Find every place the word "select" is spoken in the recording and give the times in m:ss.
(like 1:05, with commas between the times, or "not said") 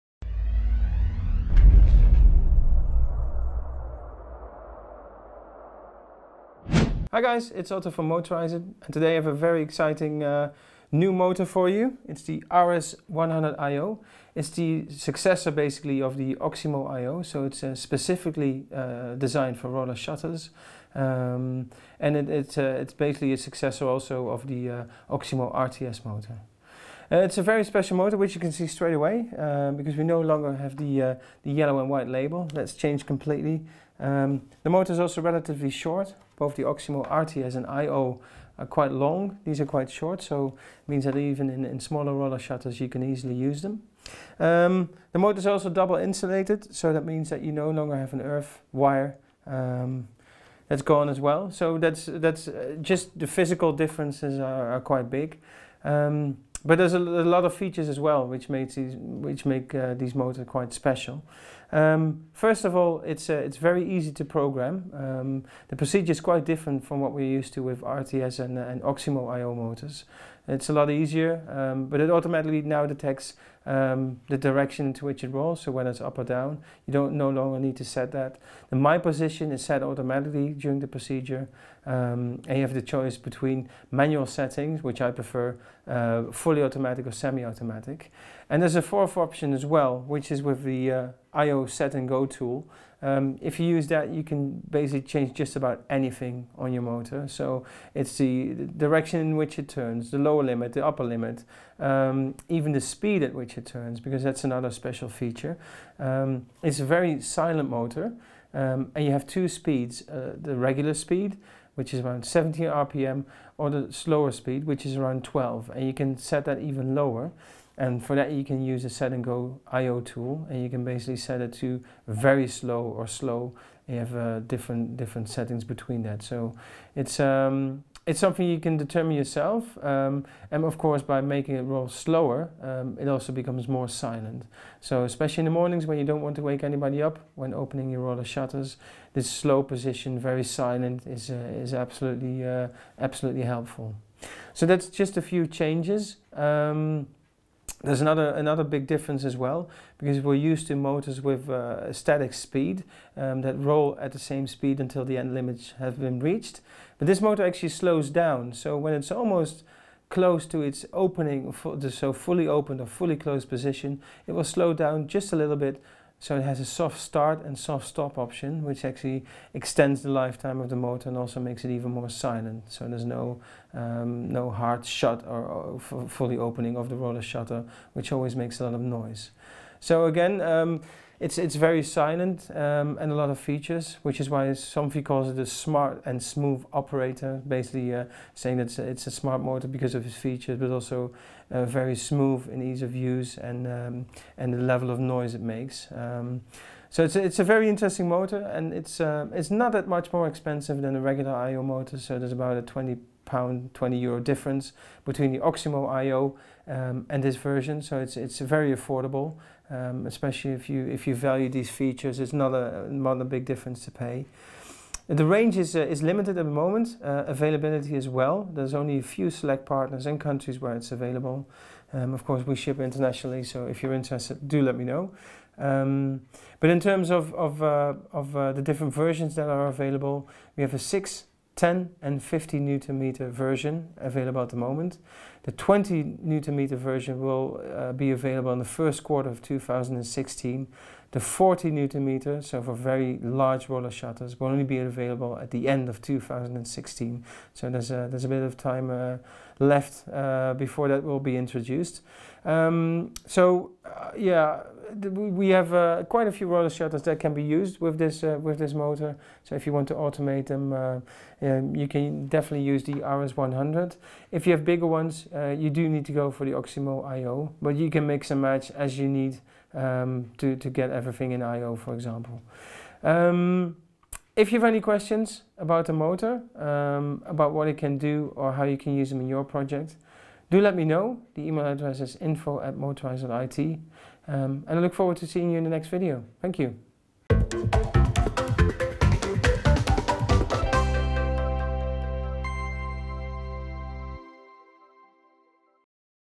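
3:39.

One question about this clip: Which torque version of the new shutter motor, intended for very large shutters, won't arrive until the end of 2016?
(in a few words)
40 newton meter.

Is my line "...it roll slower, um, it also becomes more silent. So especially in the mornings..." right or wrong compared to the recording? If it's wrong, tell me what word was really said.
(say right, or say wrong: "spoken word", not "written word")
right.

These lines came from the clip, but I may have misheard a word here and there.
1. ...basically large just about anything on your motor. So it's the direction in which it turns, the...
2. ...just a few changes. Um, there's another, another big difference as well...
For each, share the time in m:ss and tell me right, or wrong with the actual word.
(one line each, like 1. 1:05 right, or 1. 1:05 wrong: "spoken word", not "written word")
1. 1:34 wrong: "change", not "large"
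2. 2:24 right.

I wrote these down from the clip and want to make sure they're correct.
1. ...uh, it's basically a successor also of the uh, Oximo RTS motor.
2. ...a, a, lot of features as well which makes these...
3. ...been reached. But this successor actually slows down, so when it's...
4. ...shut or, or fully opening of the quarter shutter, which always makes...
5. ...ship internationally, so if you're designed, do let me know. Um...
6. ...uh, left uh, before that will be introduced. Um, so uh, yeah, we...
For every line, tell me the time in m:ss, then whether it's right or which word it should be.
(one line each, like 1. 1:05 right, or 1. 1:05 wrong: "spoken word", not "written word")
1. 0:22 right
2. 0:56 right
3. 2:35 wrong: "motor", not "successor"
4. 2:54 wrong: "roller", not "quarter"
5. 3:42 wrong: "interested", not "designed"
6. 4:08 right.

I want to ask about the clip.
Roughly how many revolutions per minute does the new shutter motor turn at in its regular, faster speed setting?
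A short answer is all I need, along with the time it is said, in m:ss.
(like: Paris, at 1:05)
17, at 1:52.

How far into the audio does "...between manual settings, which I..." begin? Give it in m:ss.
1:23.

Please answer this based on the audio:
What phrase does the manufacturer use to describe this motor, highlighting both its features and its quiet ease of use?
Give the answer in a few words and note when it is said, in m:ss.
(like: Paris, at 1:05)
smart and smooth operator, at 3:05.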